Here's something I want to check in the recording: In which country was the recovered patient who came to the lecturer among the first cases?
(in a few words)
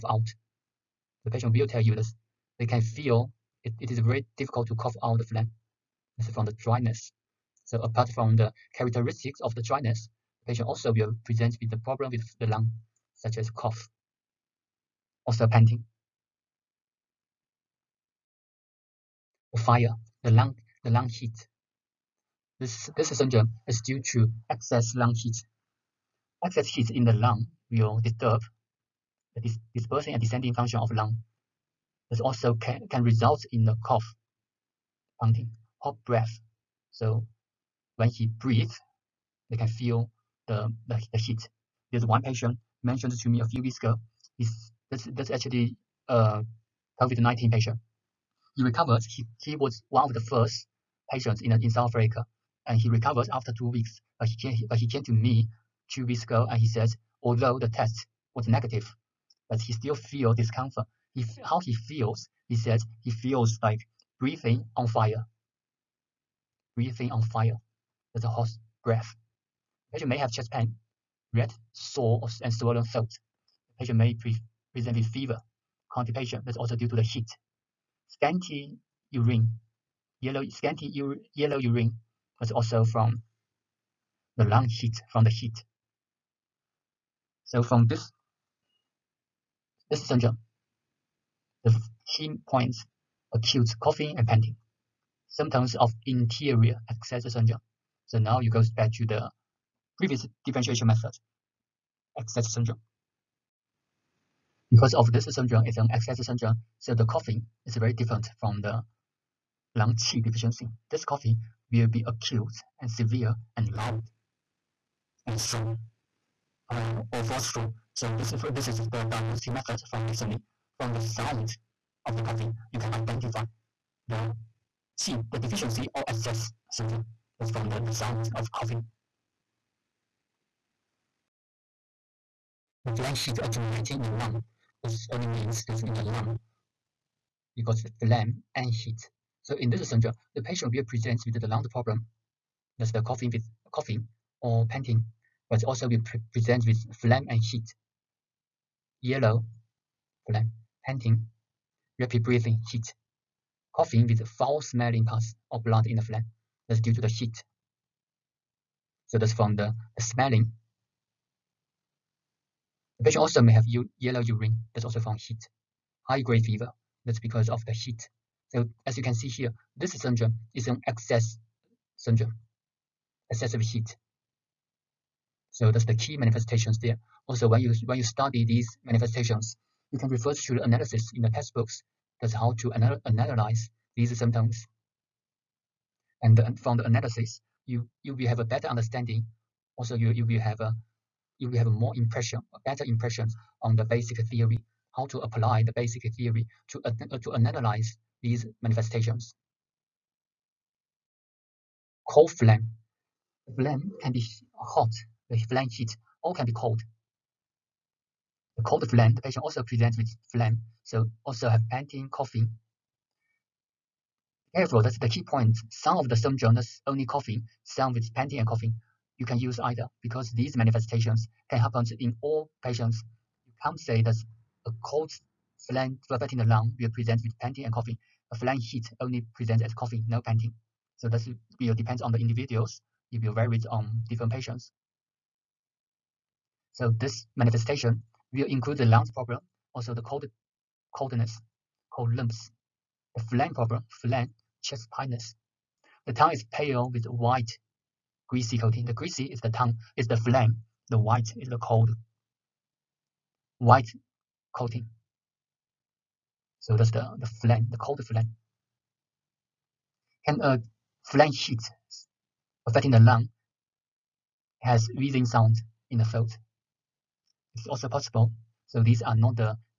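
South Africa.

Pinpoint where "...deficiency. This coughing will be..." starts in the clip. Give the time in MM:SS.
01:50.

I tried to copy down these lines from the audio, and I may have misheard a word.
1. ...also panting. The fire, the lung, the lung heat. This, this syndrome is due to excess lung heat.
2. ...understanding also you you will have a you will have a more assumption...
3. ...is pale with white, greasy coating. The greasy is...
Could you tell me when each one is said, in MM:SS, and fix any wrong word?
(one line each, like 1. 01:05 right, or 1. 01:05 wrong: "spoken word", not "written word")
1. 00:15 right
2. 03:08 wrong: "impression", not "assumption"
3. 04:06 right.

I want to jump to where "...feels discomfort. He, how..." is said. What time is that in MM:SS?
00:59.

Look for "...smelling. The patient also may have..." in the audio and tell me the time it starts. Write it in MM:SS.
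02:40.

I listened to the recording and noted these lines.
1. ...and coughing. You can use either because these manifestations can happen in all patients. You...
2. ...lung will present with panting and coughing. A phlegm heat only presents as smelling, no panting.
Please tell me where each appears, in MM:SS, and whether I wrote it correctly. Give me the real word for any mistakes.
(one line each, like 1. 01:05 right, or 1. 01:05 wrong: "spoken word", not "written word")
1. 03:38 right
2. 03:46 wrong: "coughing", not "smelling".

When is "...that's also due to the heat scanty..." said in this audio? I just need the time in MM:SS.
01:16.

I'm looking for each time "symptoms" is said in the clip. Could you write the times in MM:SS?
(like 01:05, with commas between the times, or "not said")
01:35, 03:04, 03:36.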